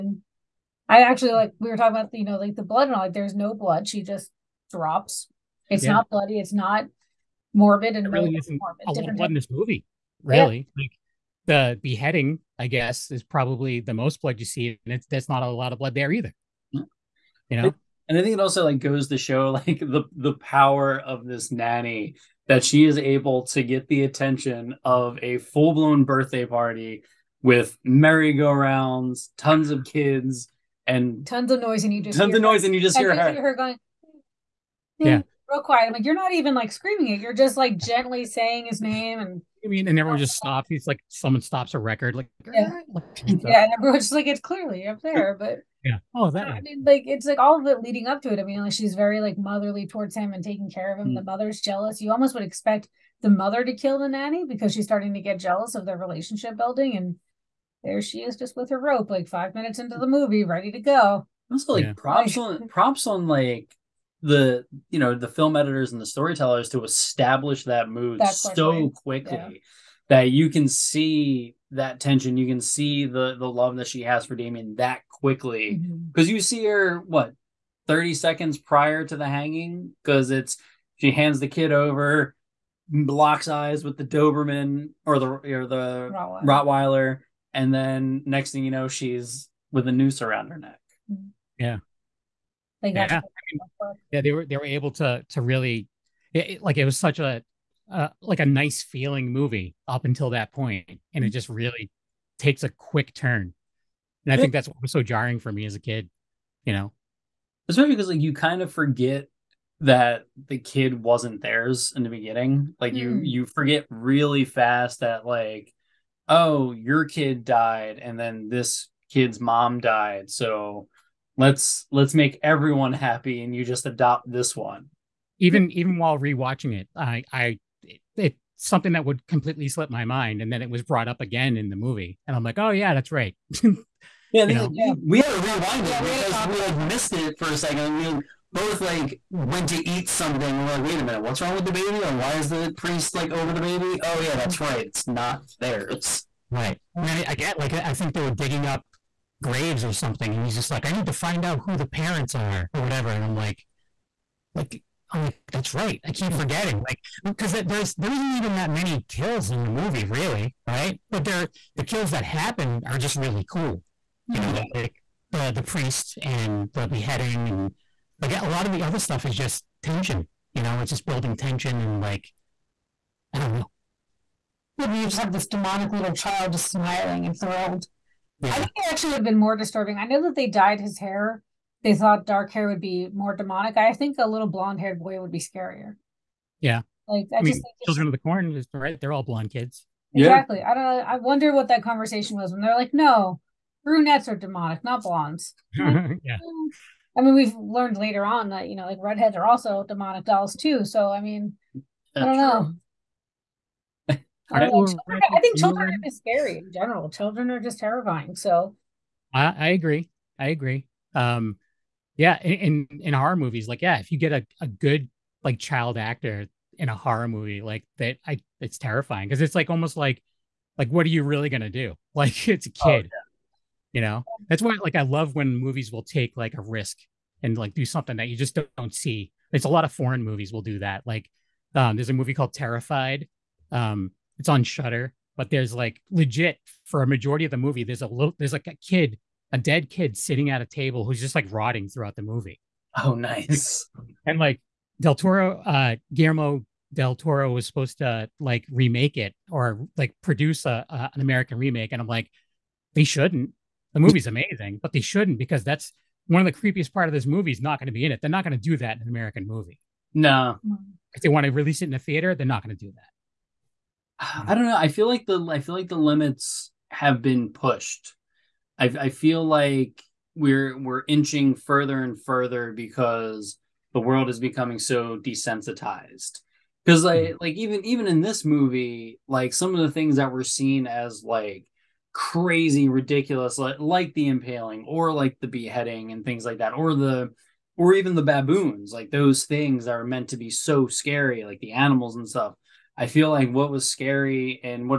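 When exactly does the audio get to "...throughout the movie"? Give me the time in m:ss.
4:01.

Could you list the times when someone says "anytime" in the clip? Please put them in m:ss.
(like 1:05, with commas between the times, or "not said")
not said.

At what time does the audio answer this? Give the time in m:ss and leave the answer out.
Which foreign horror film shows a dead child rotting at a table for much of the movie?
3:52.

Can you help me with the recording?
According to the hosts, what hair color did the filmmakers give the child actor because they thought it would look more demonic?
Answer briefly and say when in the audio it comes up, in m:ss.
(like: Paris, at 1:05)
Dark, at 3:02.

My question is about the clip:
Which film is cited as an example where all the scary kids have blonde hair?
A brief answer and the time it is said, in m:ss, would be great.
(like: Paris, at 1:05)
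Children of the Corn, at 3:07.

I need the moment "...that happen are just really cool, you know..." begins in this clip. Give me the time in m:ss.
2:42.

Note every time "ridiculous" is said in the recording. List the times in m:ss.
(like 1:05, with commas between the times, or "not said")
4:42.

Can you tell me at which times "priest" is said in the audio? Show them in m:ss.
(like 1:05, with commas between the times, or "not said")
2:22, 2:45.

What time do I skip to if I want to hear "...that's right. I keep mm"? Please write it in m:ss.
2:35.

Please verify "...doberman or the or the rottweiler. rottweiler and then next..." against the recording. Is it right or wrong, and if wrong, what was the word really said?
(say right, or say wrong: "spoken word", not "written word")
right.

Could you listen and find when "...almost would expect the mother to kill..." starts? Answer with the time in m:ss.
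0:52.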